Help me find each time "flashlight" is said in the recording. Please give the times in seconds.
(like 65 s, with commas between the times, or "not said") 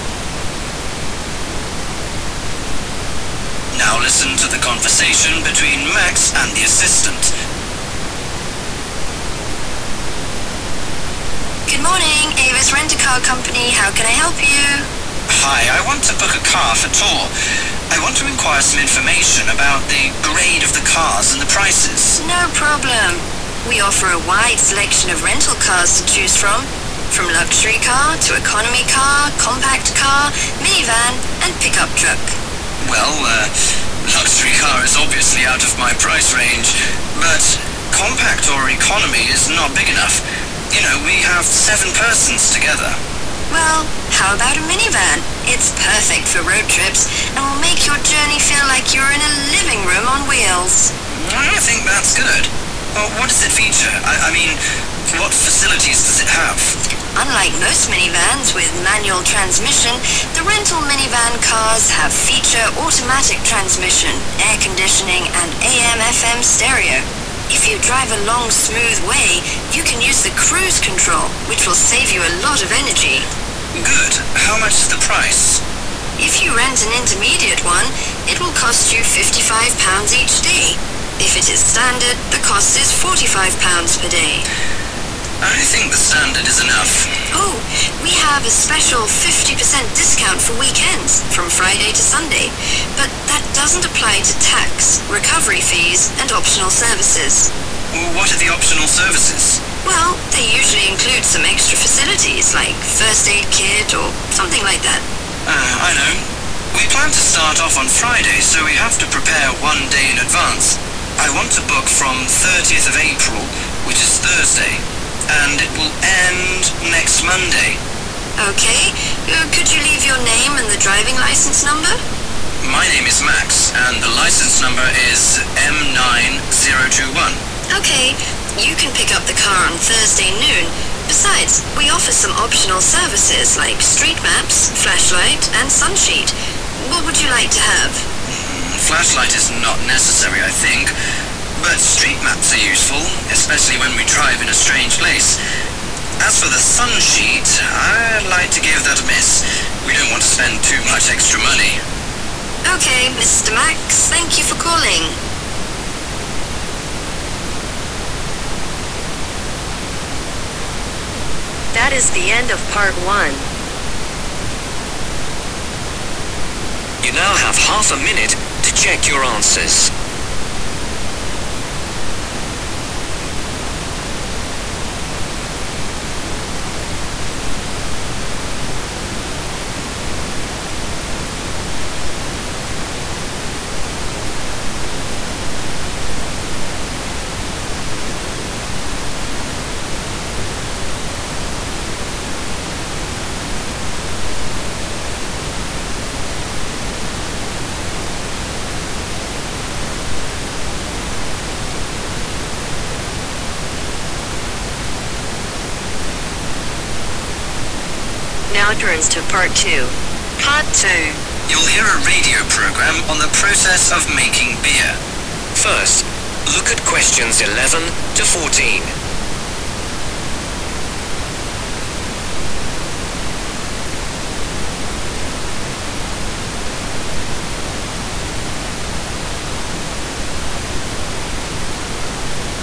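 134 s, 138 s.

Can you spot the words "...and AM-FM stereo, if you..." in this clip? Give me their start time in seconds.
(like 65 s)
65 s.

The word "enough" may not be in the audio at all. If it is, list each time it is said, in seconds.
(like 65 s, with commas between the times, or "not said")
39 s, 86 s.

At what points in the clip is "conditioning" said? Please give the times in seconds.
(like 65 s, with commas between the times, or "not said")
64 s.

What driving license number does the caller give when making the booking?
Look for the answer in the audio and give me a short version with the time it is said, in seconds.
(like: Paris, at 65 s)
M9021, at 125 s.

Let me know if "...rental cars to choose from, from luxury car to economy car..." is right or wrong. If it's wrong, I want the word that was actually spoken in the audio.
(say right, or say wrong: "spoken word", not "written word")
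right.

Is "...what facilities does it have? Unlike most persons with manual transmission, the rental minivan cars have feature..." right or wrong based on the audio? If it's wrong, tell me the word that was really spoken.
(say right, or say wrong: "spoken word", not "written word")
wrong: "minivans", not "persons".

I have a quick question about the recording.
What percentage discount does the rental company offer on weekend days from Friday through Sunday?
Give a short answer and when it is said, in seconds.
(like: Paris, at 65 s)
50%, at 89 s.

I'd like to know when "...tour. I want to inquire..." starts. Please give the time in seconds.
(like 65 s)
16 s.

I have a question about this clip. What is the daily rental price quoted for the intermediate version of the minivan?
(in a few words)
£55.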